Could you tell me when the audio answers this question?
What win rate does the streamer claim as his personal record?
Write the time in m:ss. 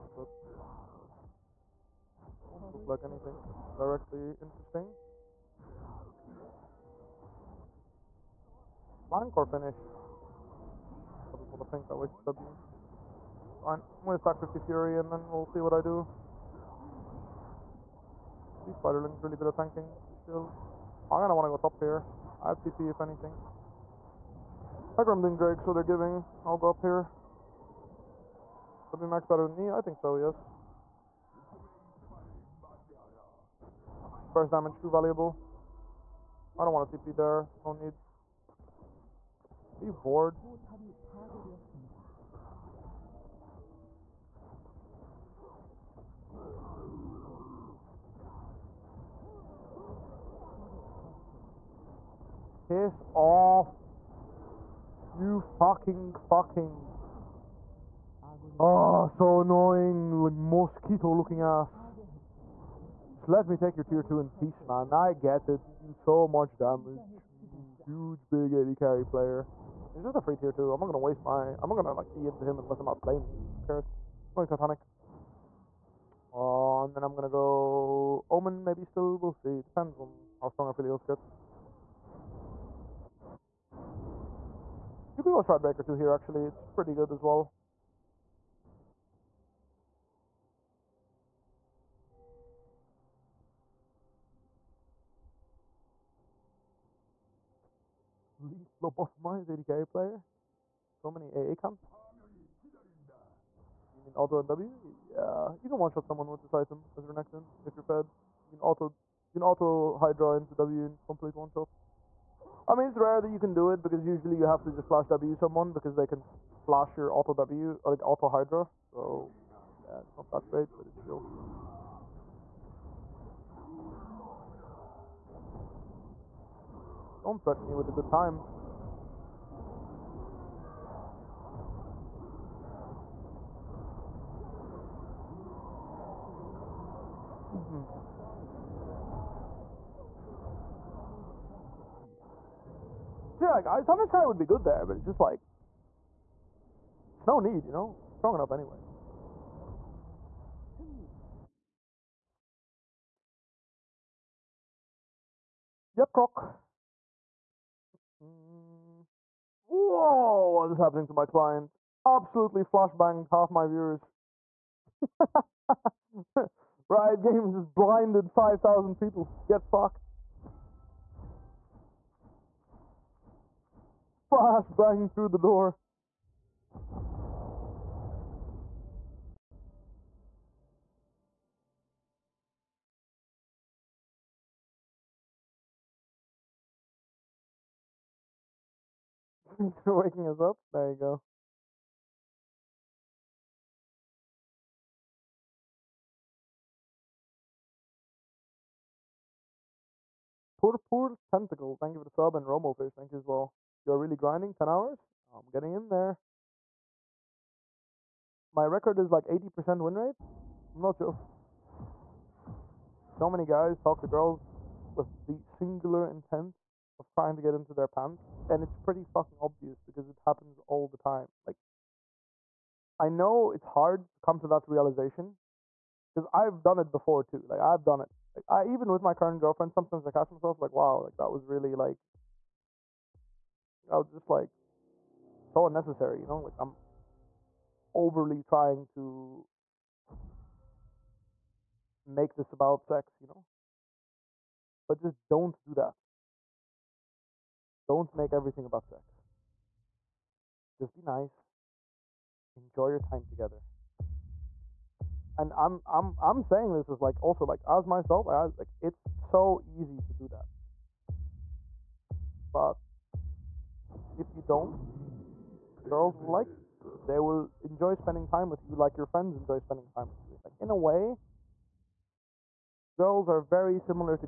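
3:29.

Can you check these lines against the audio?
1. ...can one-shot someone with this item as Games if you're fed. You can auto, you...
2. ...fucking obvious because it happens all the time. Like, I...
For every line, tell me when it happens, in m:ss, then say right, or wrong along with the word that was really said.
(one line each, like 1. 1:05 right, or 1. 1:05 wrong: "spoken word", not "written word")
1. 1:45 wrong: "Renekton", not "Games"
2. 3:39 right.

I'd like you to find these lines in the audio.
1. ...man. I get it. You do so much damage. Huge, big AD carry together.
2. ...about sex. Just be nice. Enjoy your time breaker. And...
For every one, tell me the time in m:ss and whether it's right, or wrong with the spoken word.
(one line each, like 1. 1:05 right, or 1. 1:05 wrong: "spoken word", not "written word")
1. 1:04 wrong: "player", not "together"
2. 4:08 wrong: "together", not "breaker".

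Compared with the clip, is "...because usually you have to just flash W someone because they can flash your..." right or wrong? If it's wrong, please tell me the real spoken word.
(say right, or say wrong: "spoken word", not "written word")
right.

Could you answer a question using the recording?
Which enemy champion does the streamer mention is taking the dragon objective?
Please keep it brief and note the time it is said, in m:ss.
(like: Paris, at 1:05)
Hecarim, at 0:24.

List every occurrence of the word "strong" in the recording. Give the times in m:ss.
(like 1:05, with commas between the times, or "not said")
1:20, 2:28.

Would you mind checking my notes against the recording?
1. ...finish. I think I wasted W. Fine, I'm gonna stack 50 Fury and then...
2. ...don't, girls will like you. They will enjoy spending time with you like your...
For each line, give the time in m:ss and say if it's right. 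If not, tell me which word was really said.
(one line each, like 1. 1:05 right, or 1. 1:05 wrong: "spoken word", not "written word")
1. 0:09 right
2. 4:24 right.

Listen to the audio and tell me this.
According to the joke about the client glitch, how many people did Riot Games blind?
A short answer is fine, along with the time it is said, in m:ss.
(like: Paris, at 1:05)
5,000, at 2:48.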